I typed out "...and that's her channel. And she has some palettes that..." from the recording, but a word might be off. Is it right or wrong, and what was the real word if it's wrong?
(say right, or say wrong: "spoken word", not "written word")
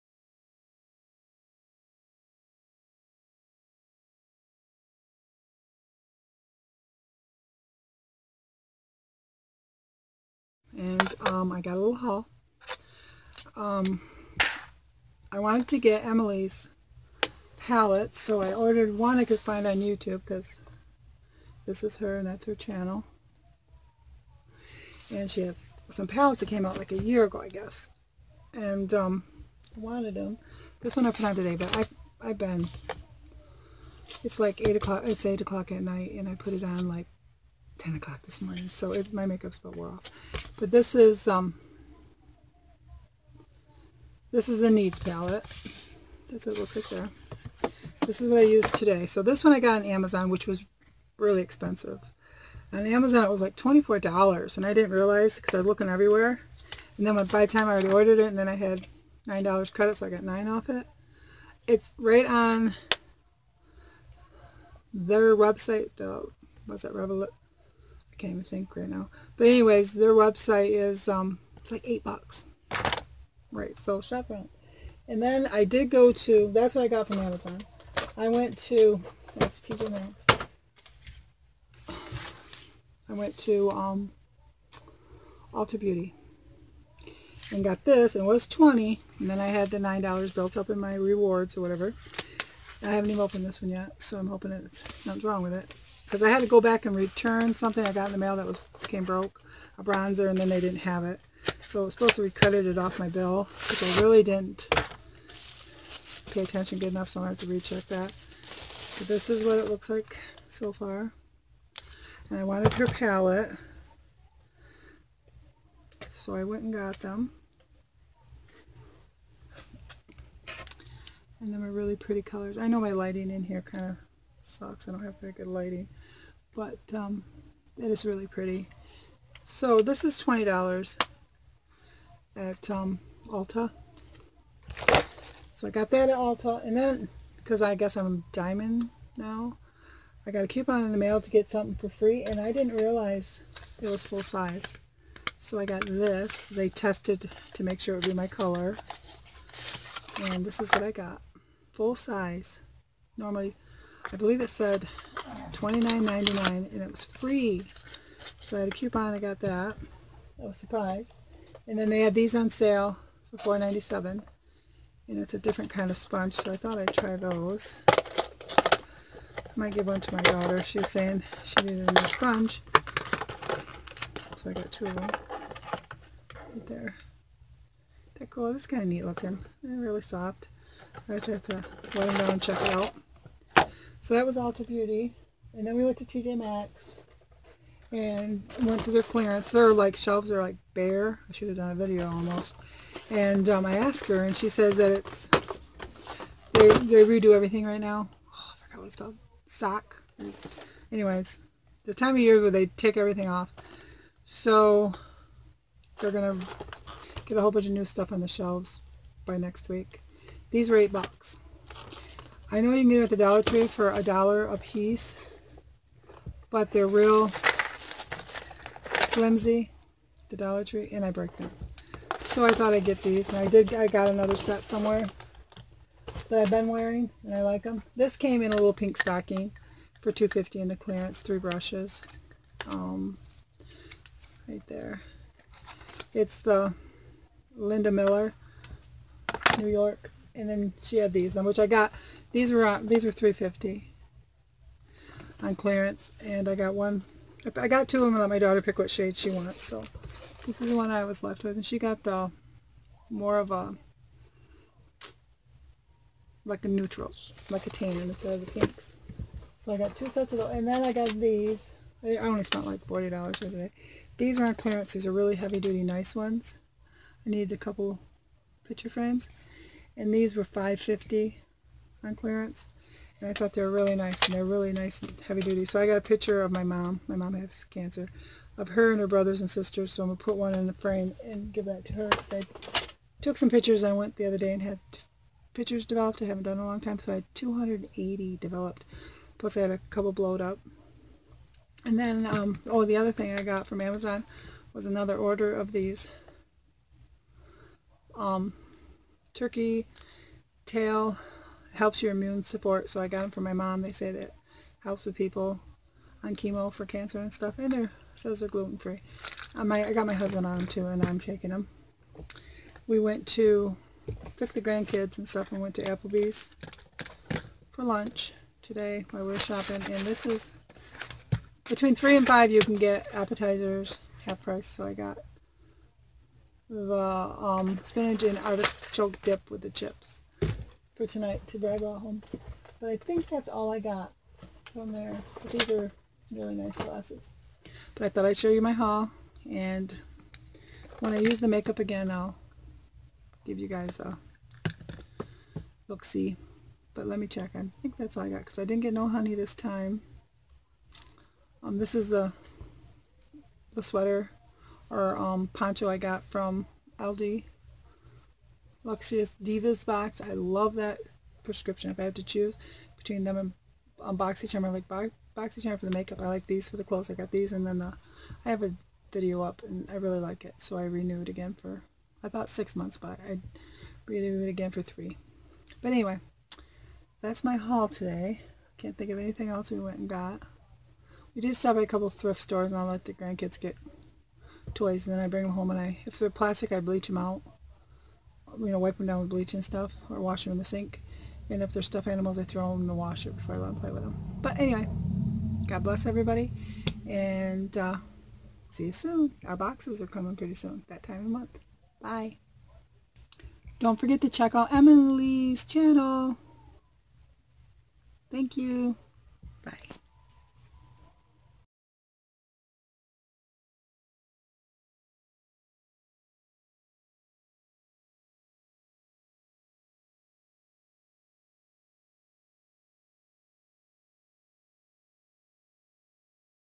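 right.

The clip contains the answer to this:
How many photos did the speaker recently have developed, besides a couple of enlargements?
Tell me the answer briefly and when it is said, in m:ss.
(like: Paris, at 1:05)
280, at 4:47.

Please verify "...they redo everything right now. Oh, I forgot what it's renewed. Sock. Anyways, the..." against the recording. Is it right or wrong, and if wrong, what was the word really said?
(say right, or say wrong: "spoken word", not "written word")
wrong: "called", not "renewed".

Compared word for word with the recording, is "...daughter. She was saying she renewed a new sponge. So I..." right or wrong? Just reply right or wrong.
wrong.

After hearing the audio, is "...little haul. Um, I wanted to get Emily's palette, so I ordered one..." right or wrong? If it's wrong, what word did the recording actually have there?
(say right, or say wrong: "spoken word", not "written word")
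right.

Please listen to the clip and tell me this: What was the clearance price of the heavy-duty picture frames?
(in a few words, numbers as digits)
$5.50.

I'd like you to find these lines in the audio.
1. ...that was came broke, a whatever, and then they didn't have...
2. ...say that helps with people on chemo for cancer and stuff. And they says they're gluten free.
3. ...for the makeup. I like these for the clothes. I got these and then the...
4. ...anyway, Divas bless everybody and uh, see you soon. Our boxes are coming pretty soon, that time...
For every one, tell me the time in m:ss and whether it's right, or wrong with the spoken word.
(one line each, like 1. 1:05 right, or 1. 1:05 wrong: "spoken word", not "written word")
1. 1:38 wrong: "bronzer", not "whatever"
2. 5:03 right
3. 6:05 right
4. 6:34 wrong: "God", not "Divas".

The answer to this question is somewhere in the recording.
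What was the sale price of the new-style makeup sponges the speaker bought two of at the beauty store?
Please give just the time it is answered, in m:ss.
2:43.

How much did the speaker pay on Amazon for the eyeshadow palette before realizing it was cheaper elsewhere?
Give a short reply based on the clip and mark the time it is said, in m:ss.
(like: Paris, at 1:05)
$24, at 0:53.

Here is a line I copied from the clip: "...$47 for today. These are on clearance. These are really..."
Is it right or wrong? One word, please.
wrong.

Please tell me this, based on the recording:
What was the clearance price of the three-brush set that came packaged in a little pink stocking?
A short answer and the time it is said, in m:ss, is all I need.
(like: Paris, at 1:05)
$2.50, at 3:50.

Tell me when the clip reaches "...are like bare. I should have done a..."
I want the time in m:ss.
3:10.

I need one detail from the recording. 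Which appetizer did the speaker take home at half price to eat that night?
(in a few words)
spinach and artichoke dip.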